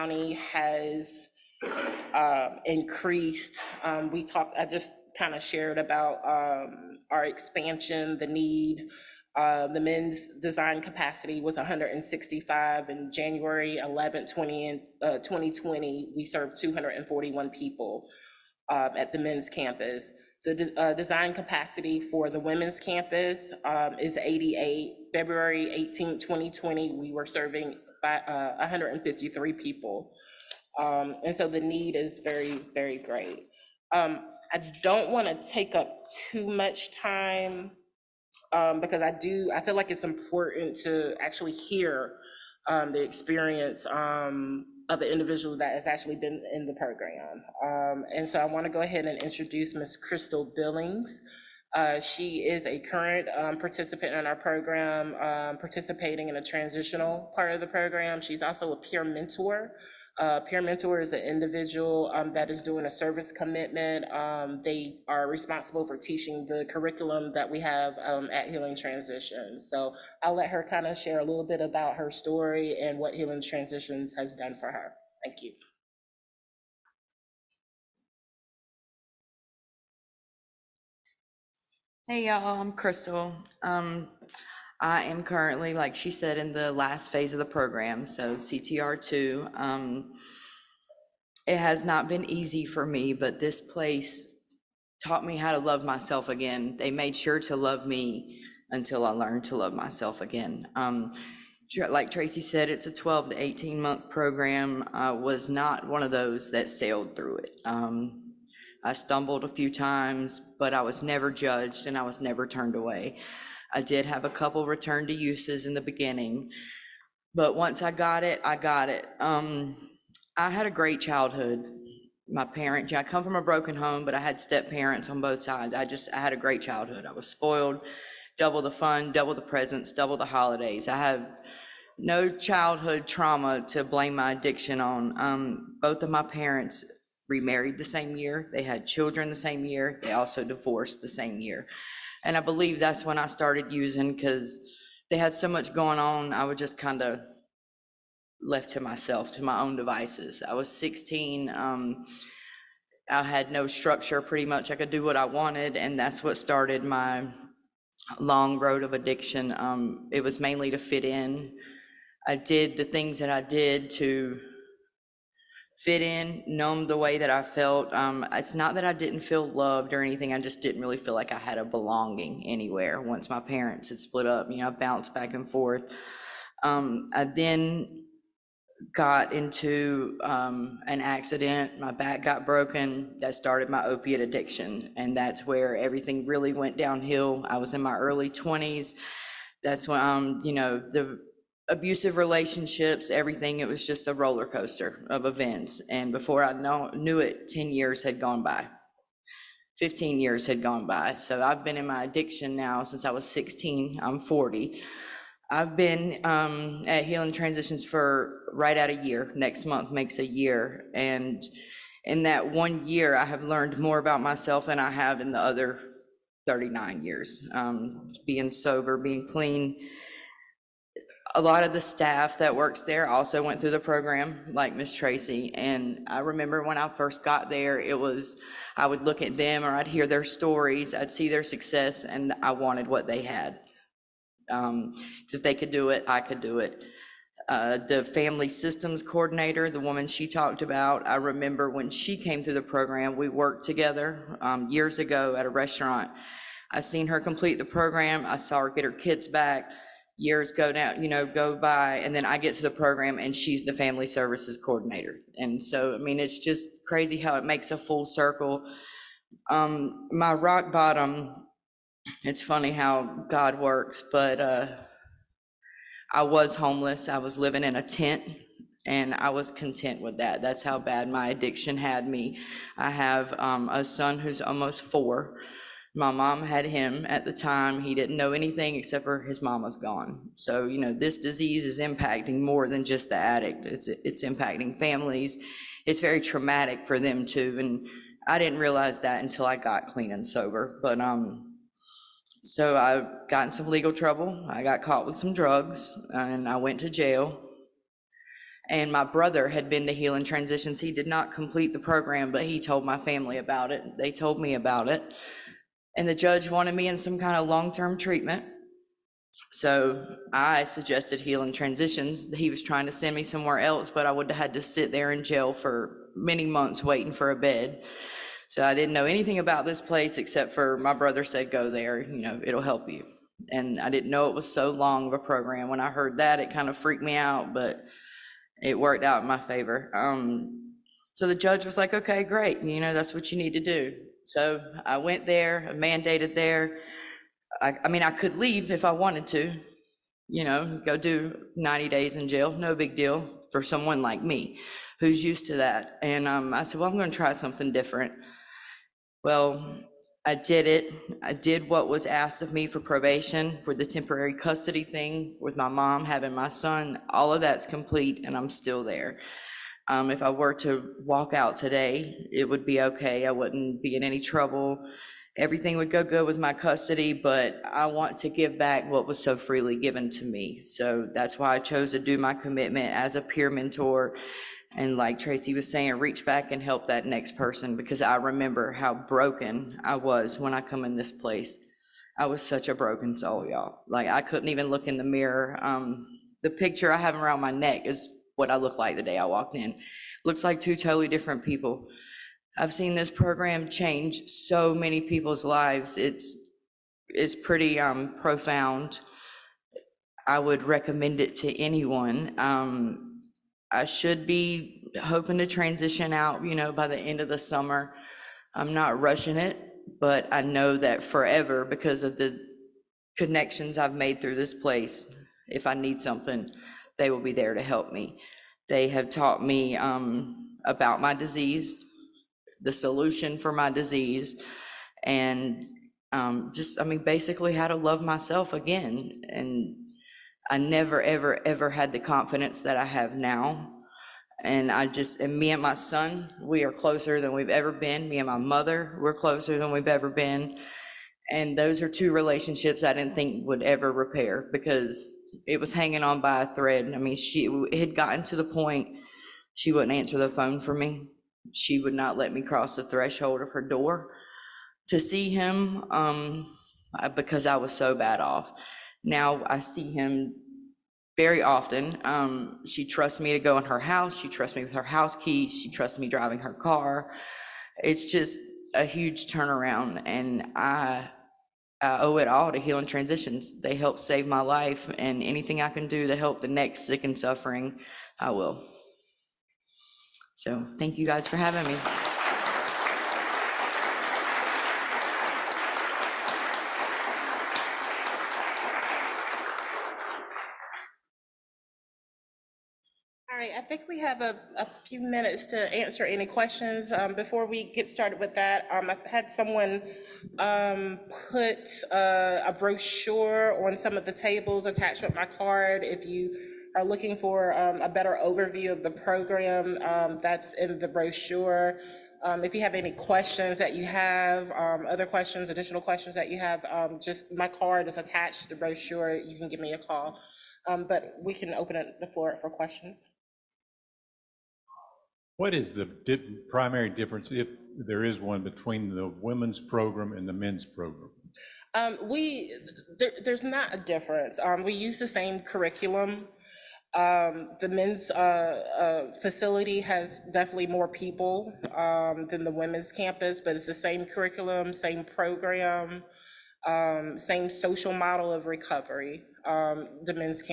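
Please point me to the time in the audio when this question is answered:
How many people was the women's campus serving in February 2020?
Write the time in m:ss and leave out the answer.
0:28.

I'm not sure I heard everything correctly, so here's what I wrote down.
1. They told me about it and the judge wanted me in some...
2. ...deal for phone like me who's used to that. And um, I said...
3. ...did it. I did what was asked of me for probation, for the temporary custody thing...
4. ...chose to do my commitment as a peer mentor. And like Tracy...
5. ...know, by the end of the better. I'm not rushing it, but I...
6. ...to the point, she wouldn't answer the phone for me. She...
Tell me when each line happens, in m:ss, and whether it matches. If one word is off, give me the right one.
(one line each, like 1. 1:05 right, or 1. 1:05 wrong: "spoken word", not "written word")
1. 5:03 right
2. 5:42 wrong: "someone", not "phone"
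3. 5:50 right
4. 6:11 right
5. 6:46 wrong: "summer", not "better"
6. 7:28 right.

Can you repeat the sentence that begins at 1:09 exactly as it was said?
So I'll let her kind of share a little bit about her story and what Healing Transitions has done for her.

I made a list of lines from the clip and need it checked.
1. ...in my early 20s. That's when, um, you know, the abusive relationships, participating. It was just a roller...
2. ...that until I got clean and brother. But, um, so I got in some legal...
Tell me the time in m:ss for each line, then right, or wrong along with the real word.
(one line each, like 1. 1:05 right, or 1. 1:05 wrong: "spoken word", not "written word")
1. 3:07 wrong: "everything", not "participating"
2. 4:49 wrong: "sober", not "brother".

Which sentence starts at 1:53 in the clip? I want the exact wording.
I did have a couple return to uses in the beginning, but once I got it, I got it.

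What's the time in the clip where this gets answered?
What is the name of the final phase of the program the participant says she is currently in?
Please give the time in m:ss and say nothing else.
1:28.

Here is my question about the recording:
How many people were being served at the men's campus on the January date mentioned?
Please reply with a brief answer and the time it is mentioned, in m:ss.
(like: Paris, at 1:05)
241, at 0:16.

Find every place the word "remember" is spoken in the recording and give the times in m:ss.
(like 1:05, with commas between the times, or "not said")
3:46, 4:01, 6:18.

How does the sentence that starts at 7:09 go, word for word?
And I never, ever, ever had the confidence that I have now.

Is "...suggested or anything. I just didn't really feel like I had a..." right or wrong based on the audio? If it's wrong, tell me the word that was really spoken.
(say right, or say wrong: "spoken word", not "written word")
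wrong: "loved", not "suggested".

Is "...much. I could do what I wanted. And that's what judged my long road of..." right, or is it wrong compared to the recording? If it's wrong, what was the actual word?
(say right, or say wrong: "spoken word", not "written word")
wrong: "started", not "judged".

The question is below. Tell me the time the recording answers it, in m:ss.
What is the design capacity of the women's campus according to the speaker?
0:24.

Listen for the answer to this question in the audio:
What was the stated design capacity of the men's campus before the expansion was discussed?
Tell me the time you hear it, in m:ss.
0:11.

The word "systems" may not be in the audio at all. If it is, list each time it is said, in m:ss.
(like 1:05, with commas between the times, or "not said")
3:58.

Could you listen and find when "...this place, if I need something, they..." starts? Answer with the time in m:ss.
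6:54.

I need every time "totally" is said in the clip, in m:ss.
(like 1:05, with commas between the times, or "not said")
6:30.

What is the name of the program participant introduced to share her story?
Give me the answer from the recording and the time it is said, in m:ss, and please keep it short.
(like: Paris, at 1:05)
Crystal Billings, at 0:49.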